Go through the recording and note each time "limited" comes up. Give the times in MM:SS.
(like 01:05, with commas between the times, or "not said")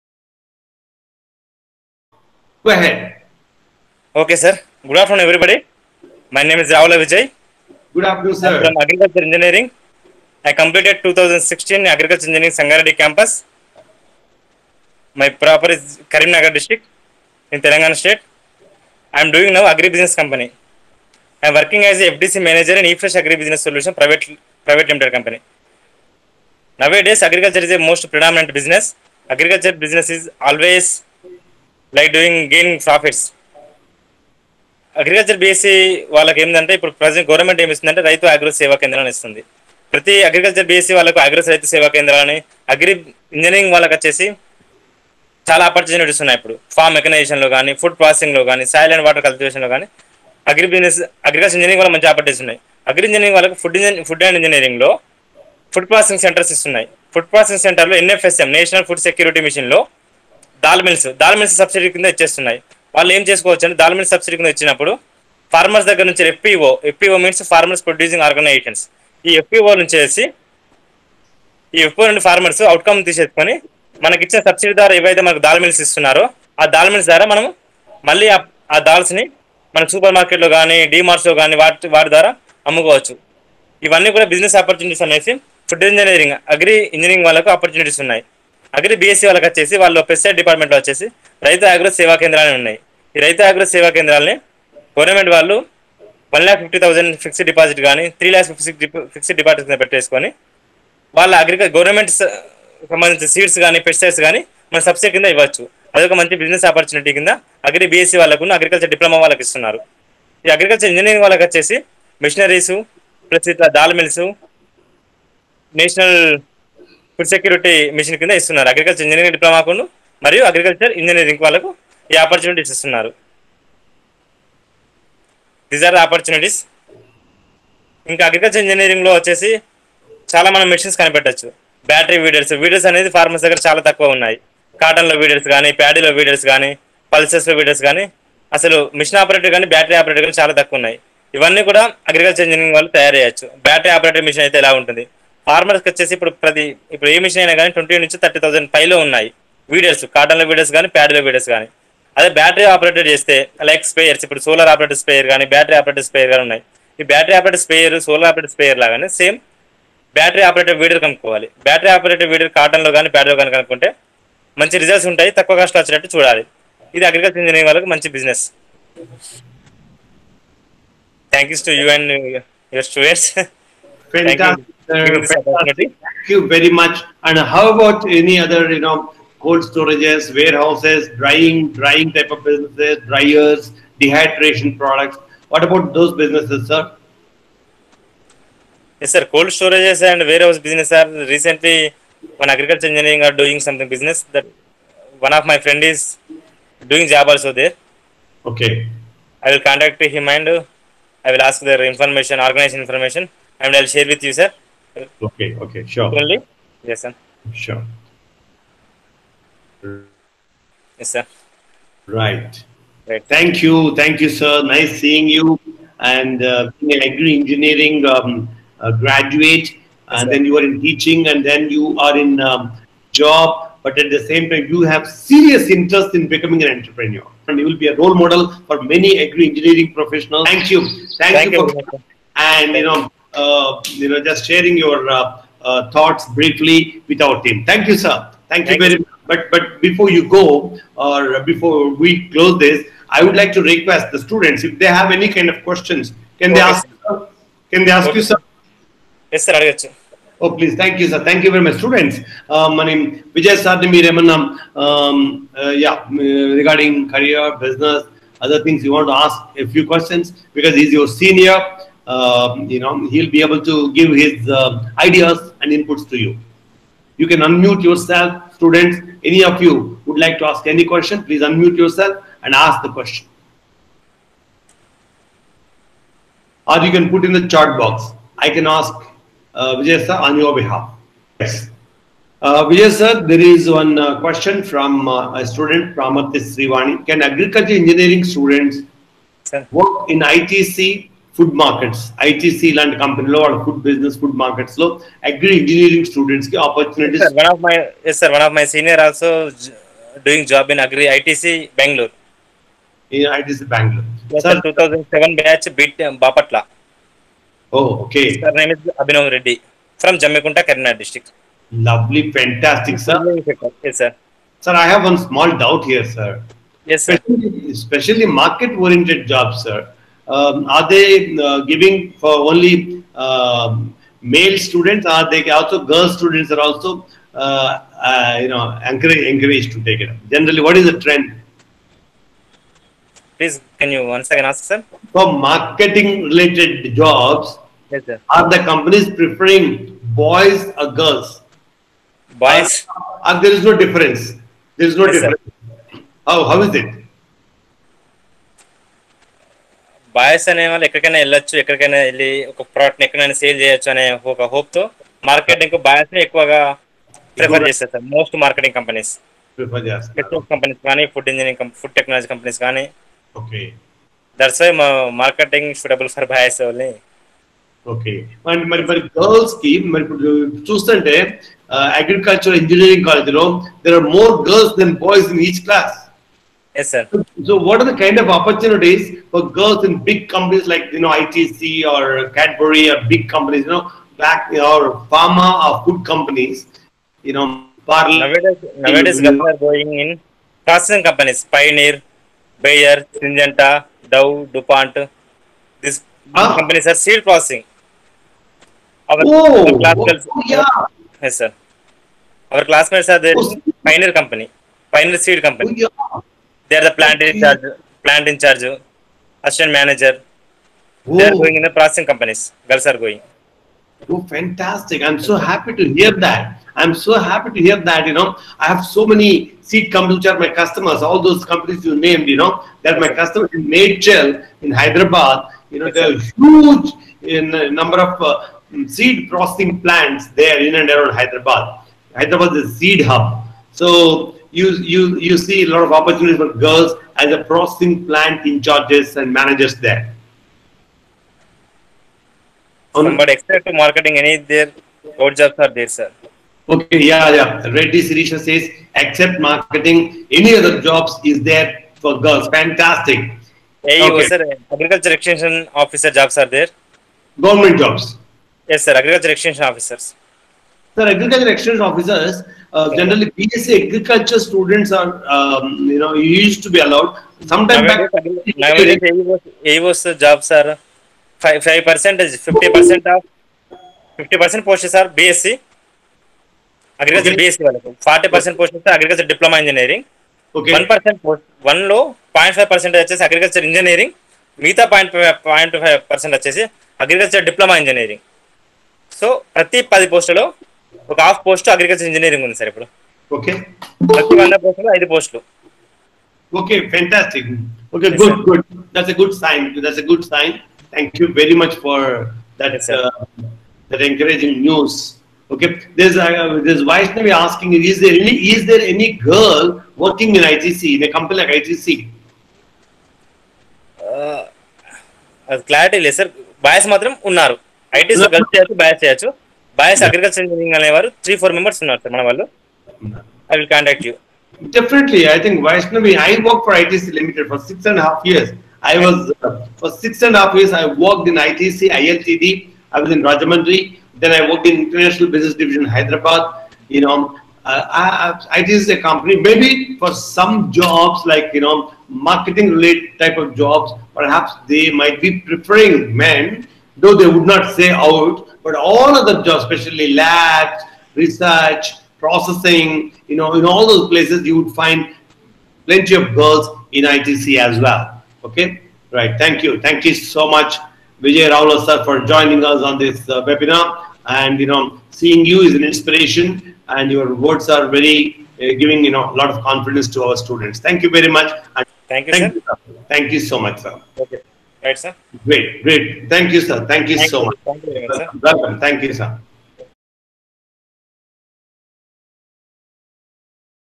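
00:24, 08:47.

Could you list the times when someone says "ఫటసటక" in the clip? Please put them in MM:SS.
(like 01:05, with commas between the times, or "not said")
05:12, 08:16.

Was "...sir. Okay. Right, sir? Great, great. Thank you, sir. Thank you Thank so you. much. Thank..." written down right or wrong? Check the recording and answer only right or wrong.
right.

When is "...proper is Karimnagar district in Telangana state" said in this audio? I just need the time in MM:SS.
00:15.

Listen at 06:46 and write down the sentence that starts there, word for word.
They are the plant in charge, plant in charge, assistant manager.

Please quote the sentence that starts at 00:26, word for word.
Nowadays, agriculture is a most predominant business.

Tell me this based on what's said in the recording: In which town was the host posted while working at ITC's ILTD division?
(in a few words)
Rajahmundry.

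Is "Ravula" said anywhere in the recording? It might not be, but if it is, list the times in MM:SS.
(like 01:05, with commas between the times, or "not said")
00:06, 09:21.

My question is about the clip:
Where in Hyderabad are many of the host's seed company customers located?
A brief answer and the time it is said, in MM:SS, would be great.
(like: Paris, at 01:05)
Medchal, at 07:03.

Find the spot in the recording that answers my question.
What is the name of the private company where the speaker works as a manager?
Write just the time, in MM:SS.
00:22.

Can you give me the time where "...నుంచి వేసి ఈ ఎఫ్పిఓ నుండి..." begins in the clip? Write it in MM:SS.
01:09.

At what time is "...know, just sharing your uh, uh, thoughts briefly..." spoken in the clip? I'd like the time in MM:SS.
03:54.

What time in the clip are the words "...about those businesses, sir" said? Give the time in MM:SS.
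03:05.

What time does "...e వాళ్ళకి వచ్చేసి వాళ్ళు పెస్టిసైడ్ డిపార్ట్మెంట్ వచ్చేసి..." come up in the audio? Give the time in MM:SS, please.
01:29.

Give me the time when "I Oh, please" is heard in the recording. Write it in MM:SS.
04:09.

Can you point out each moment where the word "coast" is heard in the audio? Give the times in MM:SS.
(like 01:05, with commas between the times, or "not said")
not said.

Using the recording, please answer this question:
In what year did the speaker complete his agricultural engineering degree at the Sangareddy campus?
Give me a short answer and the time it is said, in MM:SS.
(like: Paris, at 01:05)
2016, at 00:11.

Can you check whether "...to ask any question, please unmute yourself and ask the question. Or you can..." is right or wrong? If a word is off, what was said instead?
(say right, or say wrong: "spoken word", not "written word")
right.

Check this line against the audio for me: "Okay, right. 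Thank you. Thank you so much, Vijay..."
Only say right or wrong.
right.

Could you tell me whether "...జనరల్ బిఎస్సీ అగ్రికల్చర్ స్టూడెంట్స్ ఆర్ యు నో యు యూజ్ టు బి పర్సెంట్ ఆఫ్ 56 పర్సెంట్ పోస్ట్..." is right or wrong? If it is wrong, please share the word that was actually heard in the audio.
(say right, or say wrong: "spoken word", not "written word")
wrong: "50", not "56".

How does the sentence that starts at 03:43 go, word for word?
But at the same time, you have serious interest in becoming an entrepreneur.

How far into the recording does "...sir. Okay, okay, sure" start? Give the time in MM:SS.
03:24.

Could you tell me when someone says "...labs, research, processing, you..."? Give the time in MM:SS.
09:10.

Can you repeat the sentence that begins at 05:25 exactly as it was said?
Are they also girl students are also uh, uh you know encouraged, to take it up?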